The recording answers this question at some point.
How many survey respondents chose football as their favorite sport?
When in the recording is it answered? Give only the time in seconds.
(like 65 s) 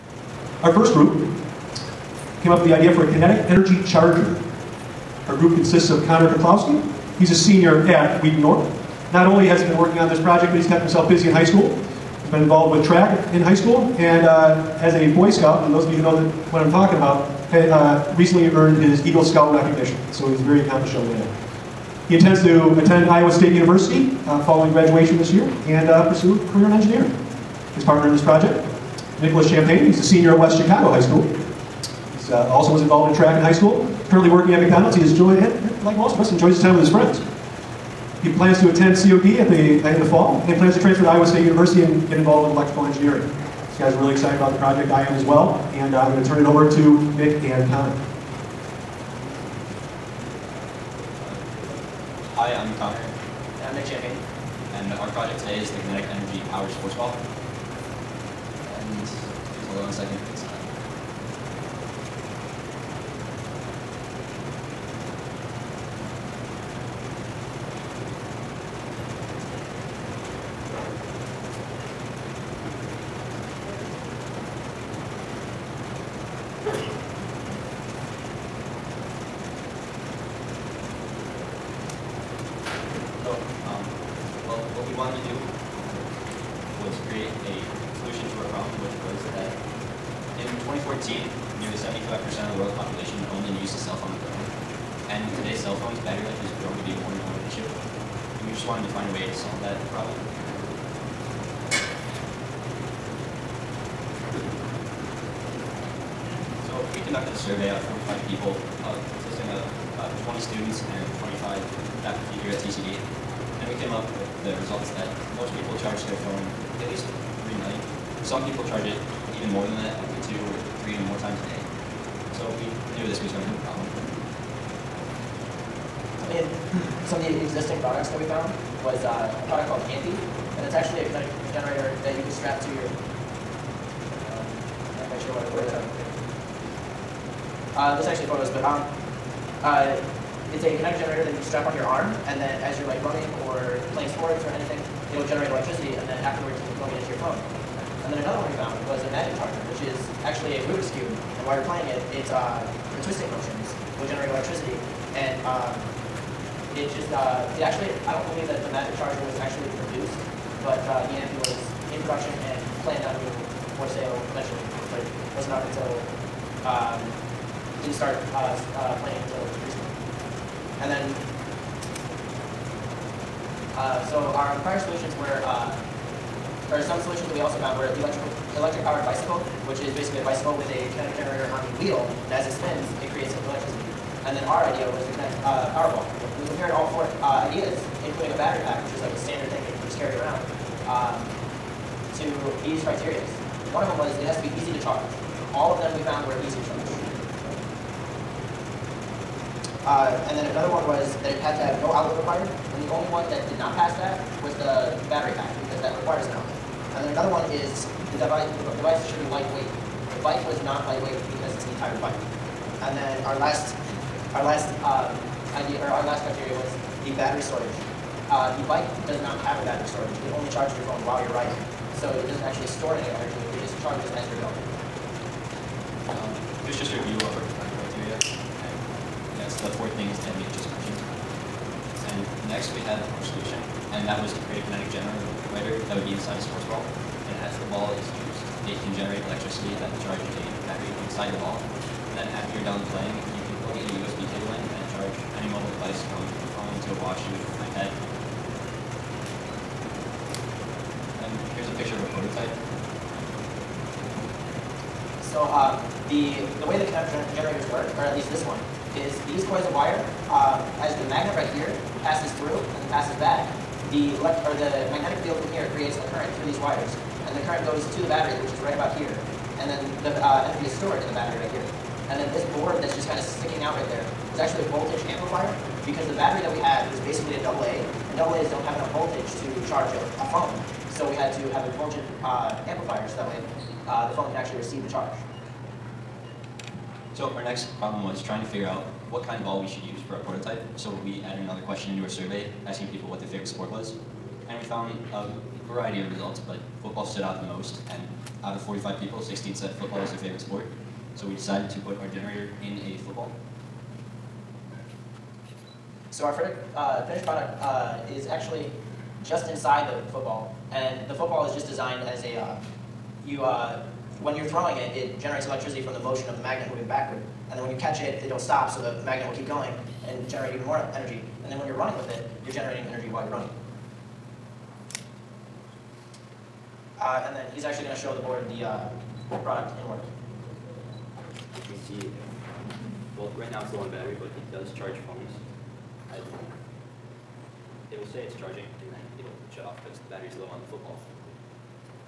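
299 s.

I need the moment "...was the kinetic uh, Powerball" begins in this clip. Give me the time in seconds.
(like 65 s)
184 s.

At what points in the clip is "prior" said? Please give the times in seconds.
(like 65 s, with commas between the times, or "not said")
174 s.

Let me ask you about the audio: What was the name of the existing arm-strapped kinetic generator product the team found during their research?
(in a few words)
AMPY.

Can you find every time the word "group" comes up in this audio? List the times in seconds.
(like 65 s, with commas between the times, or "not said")
0 s, 5 s.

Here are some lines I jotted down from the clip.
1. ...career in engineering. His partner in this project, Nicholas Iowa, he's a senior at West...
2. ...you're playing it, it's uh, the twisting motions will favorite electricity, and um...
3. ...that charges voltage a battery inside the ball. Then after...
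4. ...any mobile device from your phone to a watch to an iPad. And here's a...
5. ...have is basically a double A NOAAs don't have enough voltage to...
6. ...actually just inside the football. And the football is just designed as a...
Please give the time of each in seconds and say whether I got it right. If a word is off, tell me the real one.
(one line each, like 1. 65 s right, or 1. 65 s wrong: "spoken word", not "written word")
1. 26 s wrong: "Champagne", not "Iowa"
2. 151 s wrong: "generate", not "favorite"
3. 239 s wrong: "charge", not "voltage"
4. 245 s right
5. 276 s right
6. 308 s right.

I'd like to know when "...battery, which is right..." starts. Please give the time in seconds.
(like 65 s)
268 s.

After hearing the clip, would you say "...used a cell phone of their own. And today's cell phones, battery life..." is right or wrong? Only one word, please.
right.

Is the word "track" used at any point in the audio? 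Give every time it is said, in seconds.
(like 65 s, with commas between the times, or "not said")
12 s, 33 s.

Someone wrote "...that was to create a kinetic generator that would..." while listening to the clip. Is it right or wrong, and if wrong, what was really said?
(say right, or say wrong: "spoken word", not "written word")
right.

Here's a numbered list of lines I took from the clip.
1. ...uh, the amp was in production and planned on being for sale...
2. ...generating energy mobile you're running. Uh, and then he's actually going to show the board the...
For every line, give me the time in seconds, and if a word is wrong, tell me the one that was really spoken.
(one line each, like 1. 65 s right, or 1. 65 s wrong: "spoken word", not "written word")
1. 160 s right
2. 322 s wrong: "while", not "mobile".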